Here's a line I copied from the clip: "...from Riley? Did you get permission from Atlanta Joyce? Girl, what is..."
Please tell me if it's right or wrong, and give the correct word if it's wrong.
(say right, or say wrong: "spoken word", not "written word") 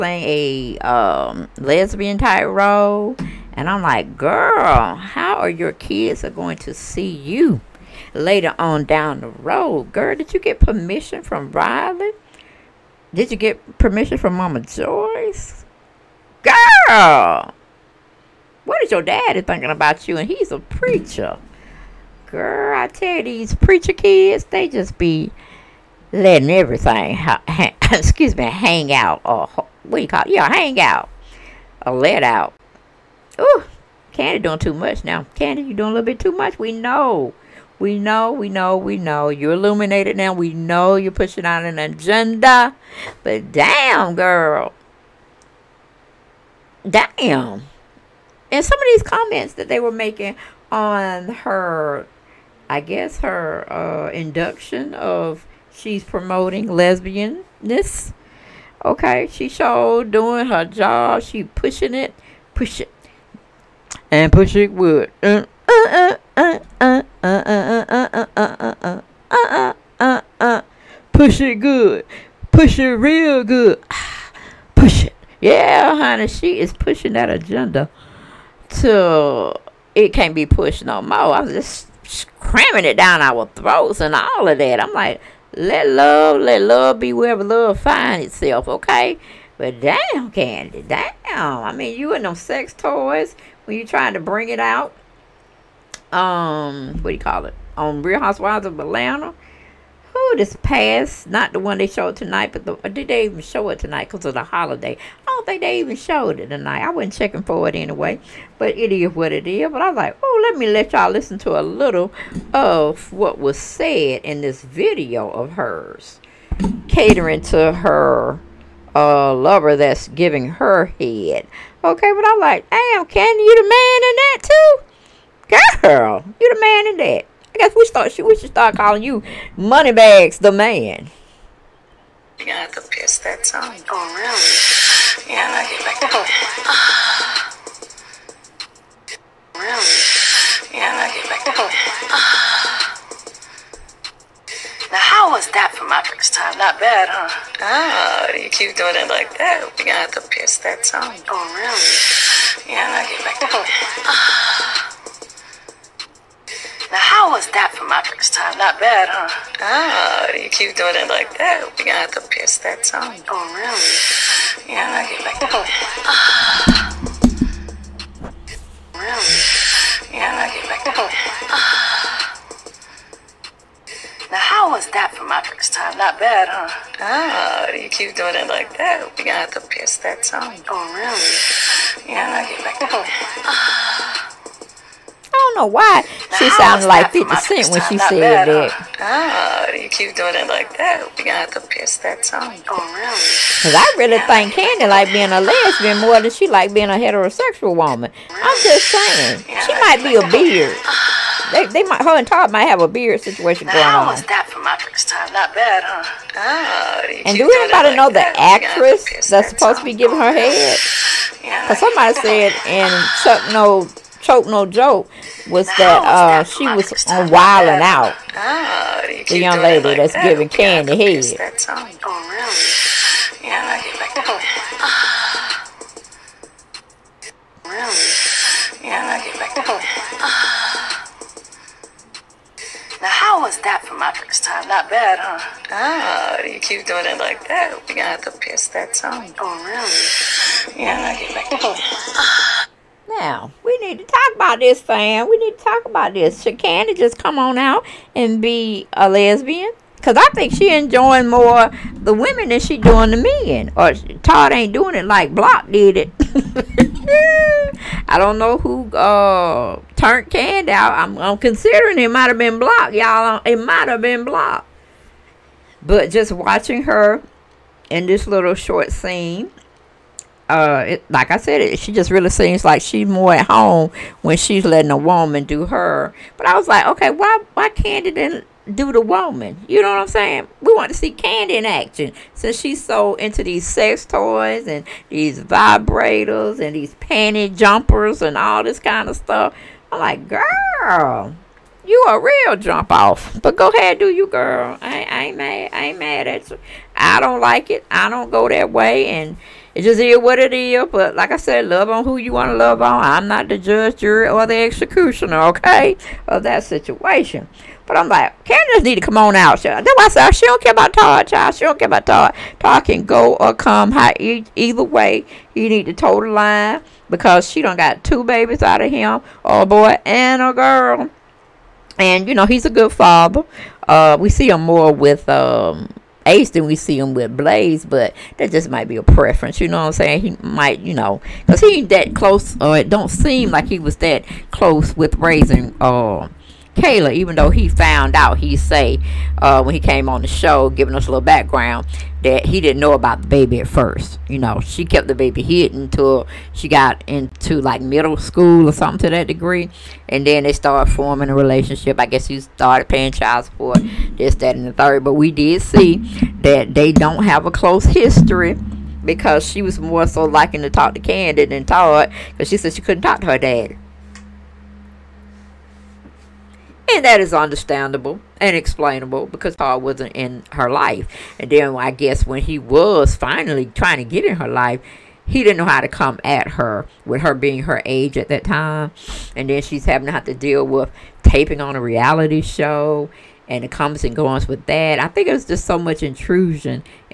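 wrong: "Mama", not "Atlanta".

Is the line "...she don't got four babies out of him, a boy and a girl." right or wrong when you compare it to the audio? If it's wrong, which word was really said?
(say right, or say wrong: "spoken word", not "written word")
wrong: "two", not "four".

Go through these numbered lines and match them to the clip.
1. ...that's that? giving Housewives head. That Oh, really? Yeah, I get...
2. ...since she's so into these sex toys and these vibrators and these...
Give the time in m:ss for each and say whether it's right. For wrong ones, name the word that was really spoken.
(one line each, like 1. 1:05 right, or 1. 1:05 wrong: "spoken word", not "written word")
1. 3:39 wrong: "Kandi", not "Housewives"
2. 4:42 right.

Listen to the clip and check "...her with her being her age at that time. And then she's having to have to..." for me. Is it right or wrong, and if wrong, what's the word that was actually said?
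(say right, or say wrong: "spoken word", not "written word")
right.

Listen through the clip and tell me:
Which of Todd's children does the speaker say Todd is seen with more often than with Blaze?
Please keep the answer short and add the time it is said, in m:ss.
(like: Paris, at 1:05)
Ace, at 5:26.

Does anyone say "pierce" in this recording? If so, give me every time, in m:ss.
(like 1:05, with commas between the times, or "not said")
2:30, 2:42, 2:59, 3:11, 3:58.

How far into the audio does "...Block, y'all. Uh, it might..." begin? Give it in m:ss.
4:22.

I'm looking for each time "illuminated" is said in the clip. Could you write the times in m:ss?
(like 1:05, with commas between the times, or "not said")
0:39.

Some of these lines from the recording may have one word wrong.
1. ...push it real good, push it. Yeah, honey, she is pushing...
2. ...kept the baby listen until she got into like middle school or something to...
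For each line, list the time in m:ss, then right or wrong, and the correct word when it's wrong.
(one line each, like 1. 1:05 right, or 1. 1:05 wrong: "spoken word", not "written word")
1. 1:12 right
2. 5:44 wrong: "hidden", not "listen".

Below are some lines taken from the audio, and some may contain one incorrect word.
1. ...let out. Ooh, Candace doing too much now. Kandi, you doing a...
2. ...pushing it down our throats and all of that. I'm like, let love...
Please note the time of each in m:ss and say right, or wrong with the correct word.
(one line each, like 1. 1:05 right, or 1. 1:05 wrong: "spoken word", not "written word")
1. 0:31 wrong: "Kandi", not "Candace"
2. 1:22 wrong: "cramming", not "pushing".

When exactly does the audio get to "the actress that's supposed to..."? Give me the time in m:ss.
3:28.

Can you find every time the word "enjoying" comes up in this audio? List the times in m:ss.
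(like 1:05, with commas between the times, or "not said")
4:10.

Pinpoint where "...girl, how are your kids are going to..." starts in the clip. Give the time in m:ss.
0:04.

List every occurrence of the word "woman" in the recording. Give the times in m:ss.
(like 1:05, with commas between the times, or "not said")
3:17, 4:34, 4:39.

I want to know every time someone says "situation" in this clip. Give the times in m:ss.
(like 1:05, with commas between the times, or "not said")
3:23, 5:06.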